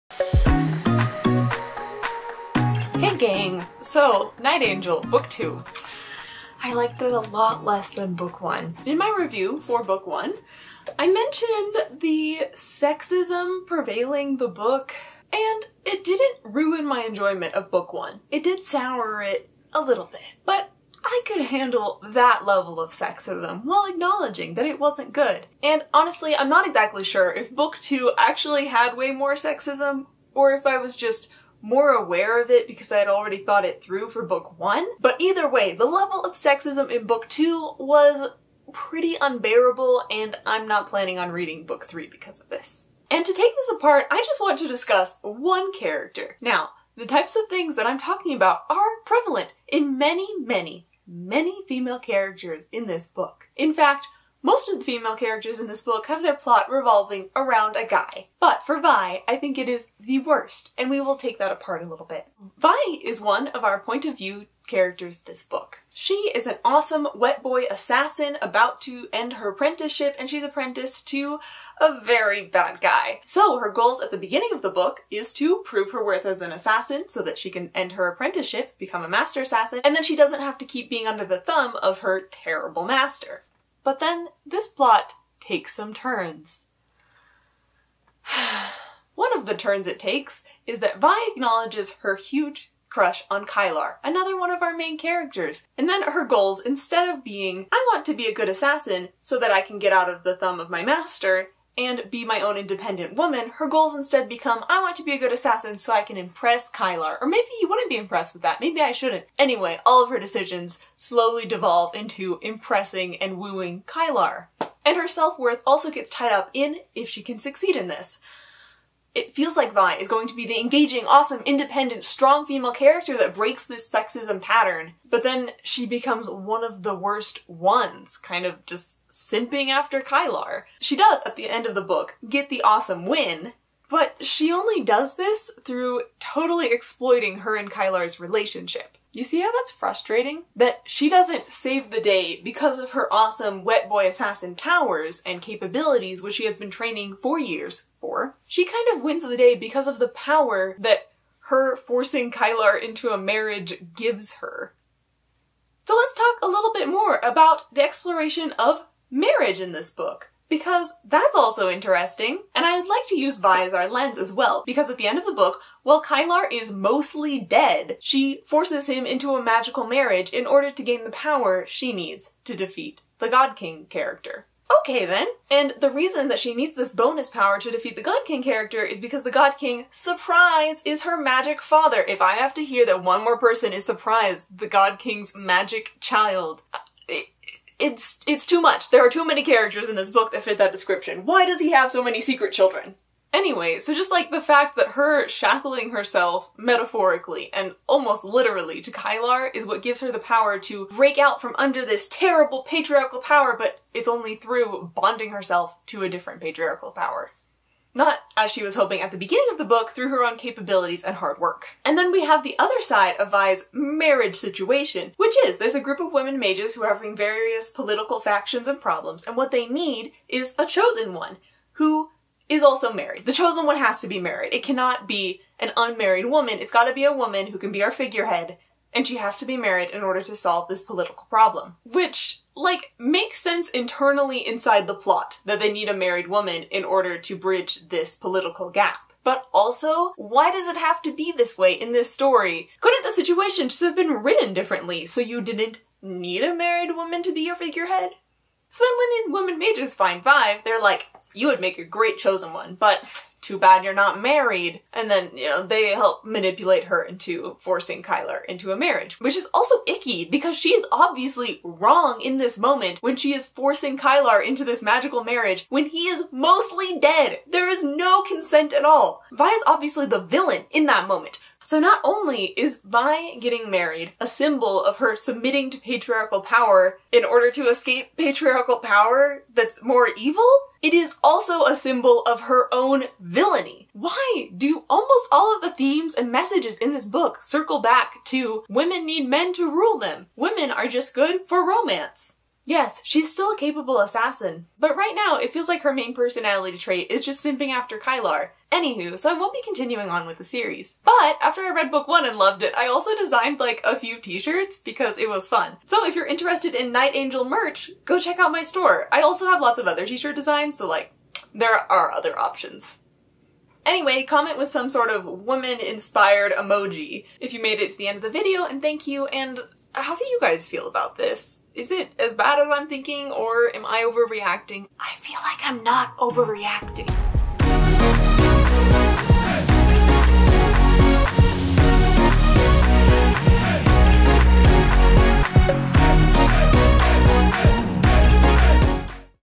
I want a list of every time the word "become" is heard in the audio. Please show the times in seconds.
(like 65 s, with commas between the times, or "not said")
78 s, 104 s, 125 s.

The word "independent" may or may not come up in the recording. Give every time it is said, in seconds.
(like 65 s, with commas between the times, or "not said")
102 s, 121 s.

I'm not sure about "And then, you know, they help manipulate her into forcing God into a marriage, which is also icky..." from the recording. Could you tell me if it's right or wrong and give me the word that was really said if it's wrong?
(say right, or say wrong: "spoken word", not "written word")
wrong: "Kylar", not "God".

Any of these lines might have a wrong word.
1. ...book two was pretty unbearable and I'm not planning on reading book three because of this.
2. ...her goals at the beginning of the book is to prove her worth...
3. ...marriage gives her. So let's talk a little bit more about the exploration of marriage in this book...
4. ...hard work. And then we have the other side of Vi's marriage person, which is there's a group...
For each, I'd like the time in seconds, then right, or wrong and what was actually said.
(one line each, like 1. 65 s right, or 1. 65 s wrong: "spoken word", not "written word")
1. 37 s right
2. 73 s right
3. 153 s right
4. 211 s wrong: "situation", not "person".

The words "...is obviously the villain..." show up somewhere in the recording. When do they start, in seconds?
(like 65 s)
269 s.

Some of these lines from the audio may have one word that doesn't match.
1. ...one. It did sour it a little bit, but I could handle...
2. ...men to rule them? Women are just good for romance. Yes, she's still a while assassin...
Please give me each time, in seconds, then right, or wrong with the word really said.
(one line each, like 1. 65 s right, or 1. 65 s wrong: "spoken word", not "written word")
1. 17 s right
2. 289 s wrong: "capable", not "while".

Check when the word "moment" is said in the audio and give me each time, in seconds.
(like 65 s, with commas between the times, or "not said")
262 s, 271 s.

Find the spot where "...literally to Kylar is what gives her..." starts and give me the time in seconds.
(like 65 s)
198 s.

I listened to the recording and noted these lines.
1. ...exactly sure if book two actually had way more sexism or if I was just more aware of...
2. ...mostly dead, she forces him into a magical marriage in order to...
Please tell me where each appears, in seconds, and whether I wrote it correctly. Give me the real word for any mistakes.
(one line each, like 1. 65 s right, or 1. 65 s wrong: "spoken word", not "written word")
1. 26 s right
2. 166 s right.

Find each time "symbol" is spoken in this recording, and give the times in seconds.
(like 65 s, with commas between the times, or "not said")
274 s, 281 s.